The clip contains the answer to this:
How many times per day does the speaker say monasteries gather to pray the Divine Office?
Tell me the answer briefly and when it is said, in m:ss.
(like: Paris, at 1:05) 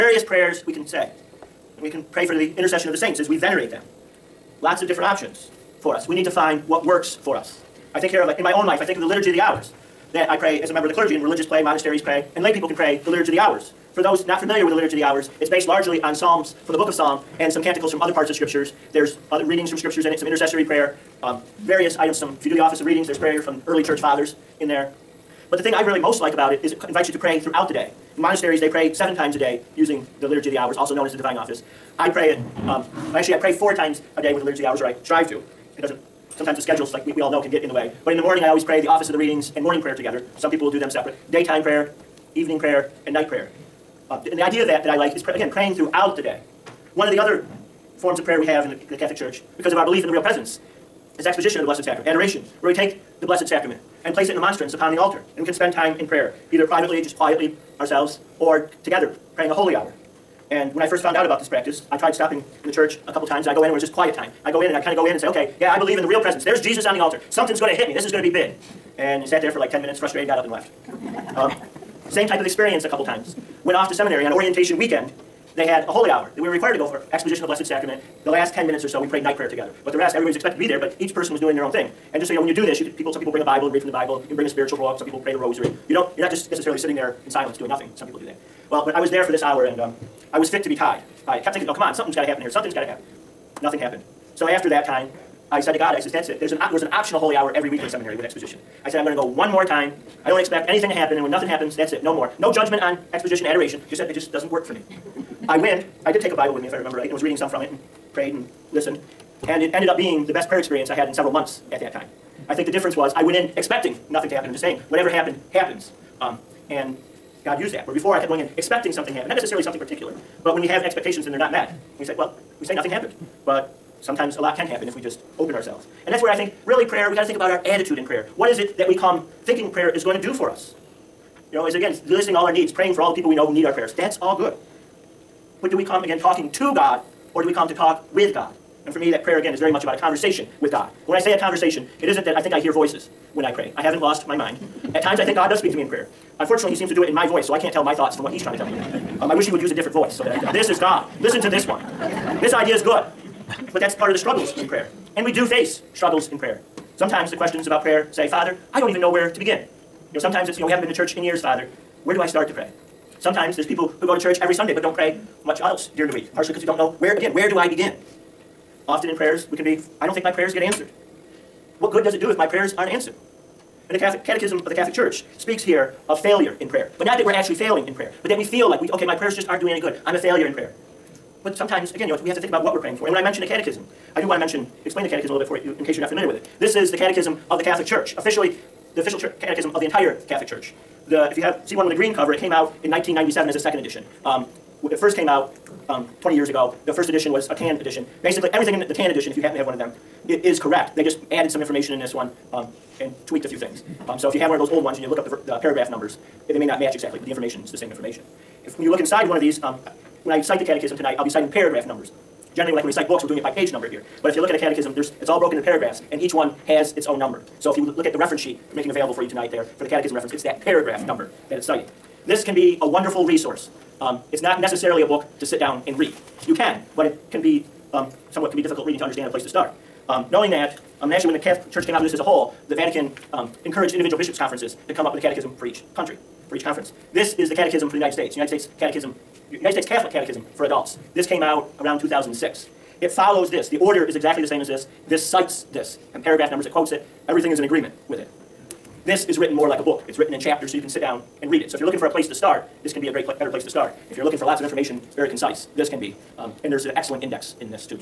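7, at 0:28.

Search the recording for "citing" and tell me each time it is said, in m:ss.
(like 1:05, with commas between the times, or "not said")
3:31, 3:41.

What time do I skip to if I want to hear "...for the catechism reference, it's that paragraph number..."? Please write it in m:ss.
3:39.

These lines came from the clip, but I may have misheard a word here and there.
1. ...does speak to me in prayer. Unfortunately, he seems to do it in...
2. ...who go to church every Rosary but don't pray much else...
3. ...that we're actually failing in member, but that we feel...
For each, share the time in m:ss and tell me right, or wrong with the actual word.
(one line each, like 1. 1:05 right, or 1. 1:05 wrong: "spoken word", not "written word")
1. 2:25 right
2. 2:43 wrong: "Sunday", not "Rosary"
3. 2:57 wrong: "prayer", not "member".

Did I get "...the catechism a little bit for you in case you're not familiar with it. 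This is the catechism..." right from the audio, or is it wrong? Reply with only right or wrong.
right.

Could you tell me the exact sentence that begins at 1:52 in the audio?
I think the difference was I went in expecting nothing to happen and just saying, whatever happened, happens.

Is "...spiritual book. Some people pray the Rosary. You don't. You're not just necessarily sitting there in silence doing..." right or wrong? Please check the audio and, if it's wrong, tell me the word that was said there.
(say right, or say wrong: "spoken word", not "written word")
right.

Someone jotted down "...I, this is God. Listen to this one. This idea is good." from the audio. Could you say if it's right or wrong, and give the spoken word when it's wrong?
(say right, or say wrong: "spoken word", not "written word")
right.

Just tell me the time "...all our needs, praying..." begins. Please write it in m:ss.
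2:12.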